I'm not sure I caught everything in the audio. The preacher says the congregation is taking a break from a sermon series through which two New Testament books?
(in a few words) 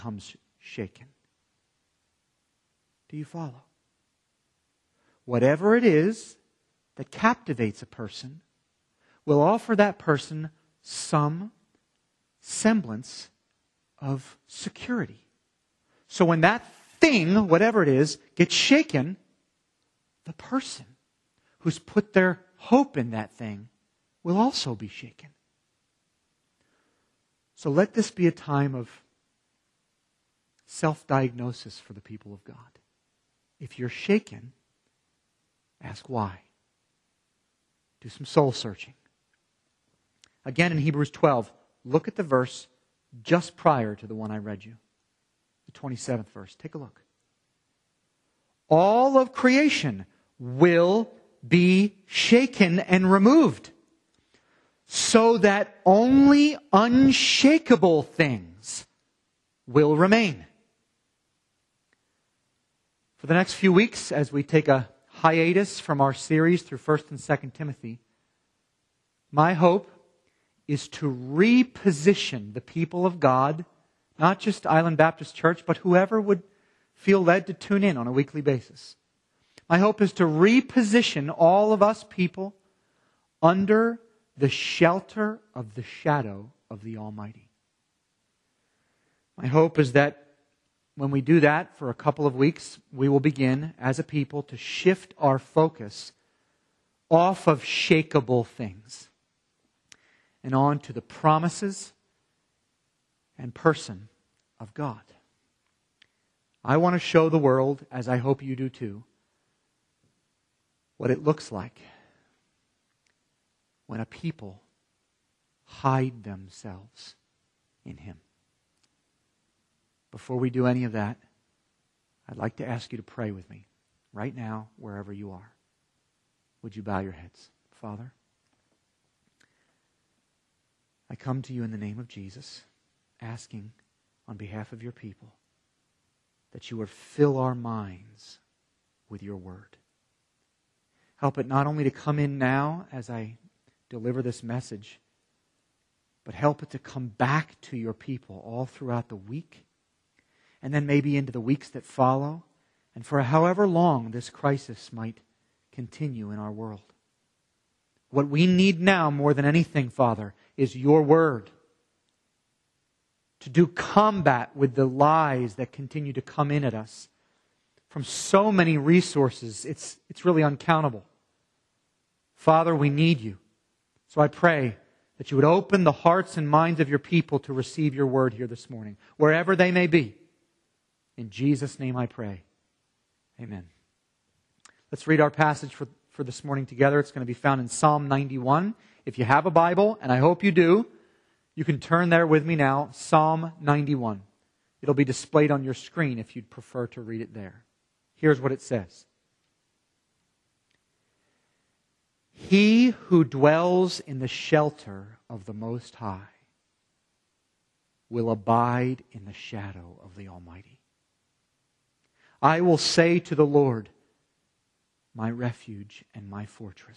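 1st and 2nd Timothy.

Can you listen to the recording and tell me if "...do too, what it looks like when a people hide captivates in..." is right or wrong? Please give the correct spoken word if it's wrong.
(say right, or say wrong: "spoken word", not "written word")
wrong: "themselves", not "captivates".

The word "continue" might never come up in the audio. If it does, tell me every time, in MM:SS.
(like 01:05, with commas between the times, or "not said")
02:35, 02:45.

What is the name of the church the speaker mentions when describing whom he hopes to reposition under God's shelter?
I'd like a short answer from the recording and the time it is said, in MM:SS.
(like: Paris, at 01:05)
Island Baptist Church, at 01:14.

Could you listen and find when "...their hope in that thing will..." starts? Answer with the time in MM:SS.
00:22.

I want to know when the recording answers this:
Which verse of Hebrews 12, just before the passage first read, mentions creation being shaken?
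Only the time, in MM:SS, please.
00:45.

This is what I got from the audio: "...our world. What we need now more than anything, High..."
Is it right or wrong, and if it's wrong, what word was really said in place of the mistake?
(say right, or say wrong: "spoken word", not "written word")
wrong: "Father", not "High".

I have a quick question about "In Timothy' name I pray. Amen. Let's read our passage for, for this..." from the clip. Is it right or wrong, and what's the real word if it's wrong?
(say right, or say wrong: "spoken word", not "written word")
wrong: "Jesus", not "Timothy".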